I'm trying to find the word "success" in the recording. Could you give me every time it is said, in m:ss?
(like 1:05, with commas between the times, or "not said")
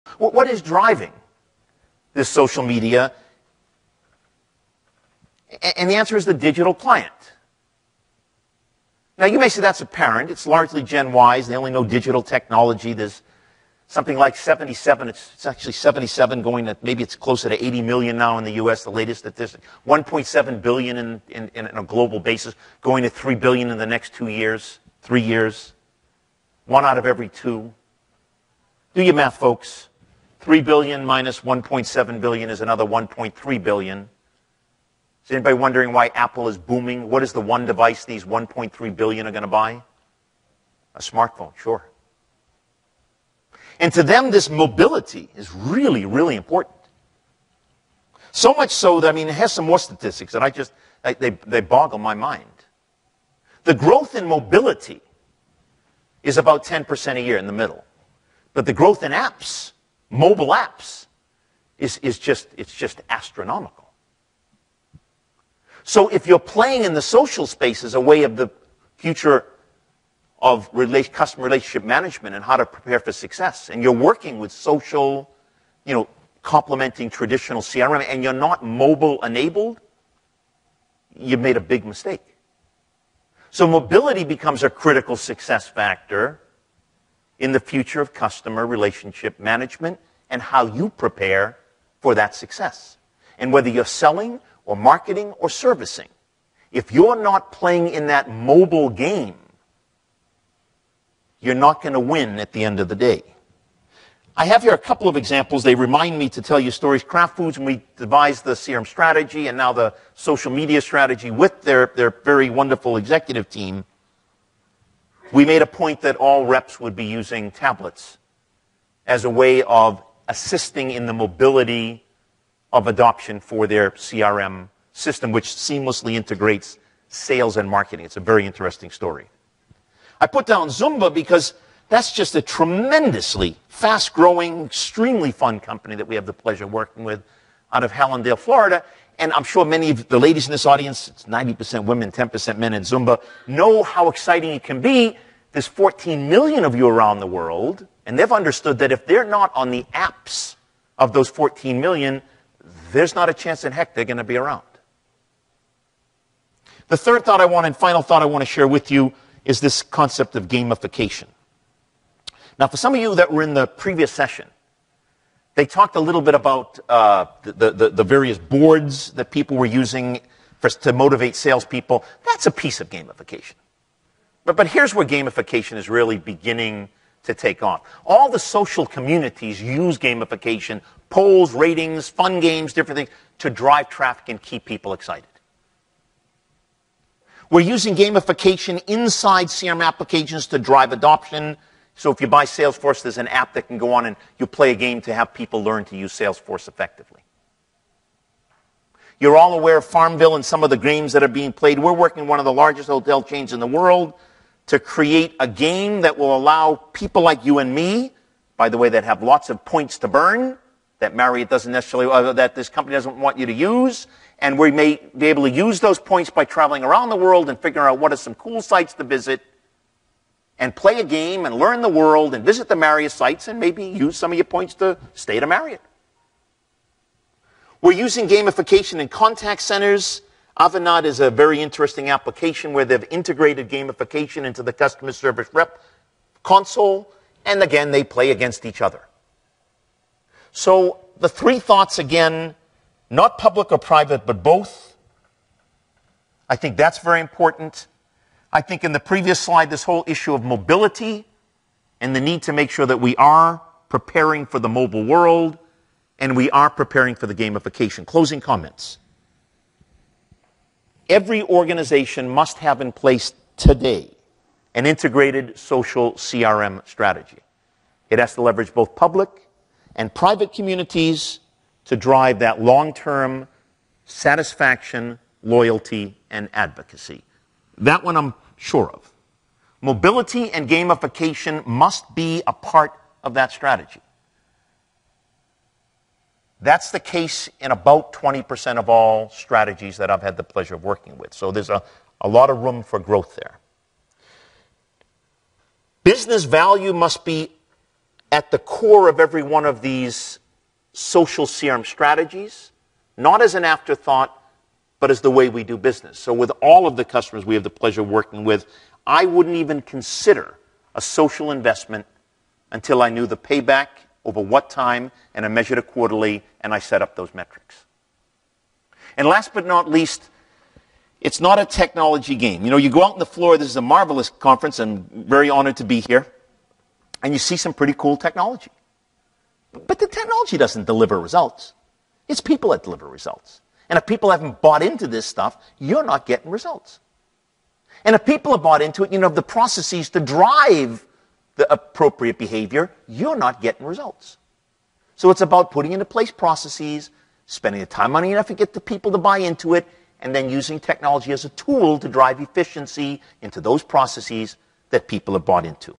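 1:13, 1:25, 1:32.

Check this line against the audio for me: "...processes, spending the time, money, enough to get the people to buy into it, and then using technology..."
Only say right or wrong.
right.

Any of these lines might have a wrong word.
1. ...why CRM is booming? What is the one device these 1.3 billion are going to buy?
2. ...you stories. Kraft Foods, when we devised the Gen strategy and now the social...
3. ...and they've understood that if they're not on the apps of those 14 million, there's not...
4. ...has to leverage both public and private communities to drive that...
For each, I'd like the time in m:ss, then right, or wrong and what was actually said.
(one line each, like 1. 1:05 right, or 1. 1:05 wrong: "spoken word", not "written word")
1. 0:35 wrong: "Apple", not "CRM"
2. 1:46 wrong: "CRM", not "Gen"
3. 2:28 right
4. 4:28 right.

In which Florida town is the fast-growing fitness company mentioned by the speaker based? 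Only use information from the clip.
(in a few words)
Hallandale, Florida.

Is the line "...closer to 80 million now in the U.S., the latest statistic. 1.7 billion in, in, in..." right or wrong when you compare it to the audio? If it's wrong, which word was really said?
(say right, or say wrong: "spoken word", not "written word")
right.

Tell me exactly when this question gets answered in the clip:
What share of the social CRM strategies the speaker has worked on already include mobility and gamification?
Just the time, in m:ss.
4:48.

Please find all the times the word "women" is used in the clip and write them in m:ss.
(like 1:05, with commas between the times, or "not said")
2:21.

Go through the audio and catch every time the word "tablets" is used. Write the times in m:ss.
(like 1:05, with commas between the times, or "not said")
1:57.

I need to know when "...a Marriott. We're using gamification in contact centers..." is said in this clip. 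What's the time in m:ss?
3:45.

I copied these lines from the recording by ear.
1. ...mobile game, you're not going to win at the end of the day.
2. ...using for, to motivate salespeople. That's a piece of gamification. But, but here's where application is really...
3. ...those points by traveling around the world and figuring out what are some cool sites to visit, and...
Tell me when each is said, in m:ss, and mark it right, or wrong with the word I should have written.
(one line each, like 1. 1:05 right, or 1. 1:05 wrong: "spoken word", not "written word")
1. 1:38 right
2. 2:49 wrong: "gamification", not "application"
3. 3:35 right.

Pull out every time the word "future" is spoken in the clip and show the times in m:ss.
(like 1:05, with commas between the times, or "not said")
1:08, 1:27.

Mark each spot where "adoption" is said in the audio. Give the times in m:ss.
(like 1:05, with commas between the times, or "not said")
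2:02, 3:10.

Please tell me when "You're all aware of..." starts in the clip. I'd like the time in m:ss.
3:19.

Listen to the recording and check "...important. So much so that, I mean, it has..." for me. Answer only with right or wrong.
right.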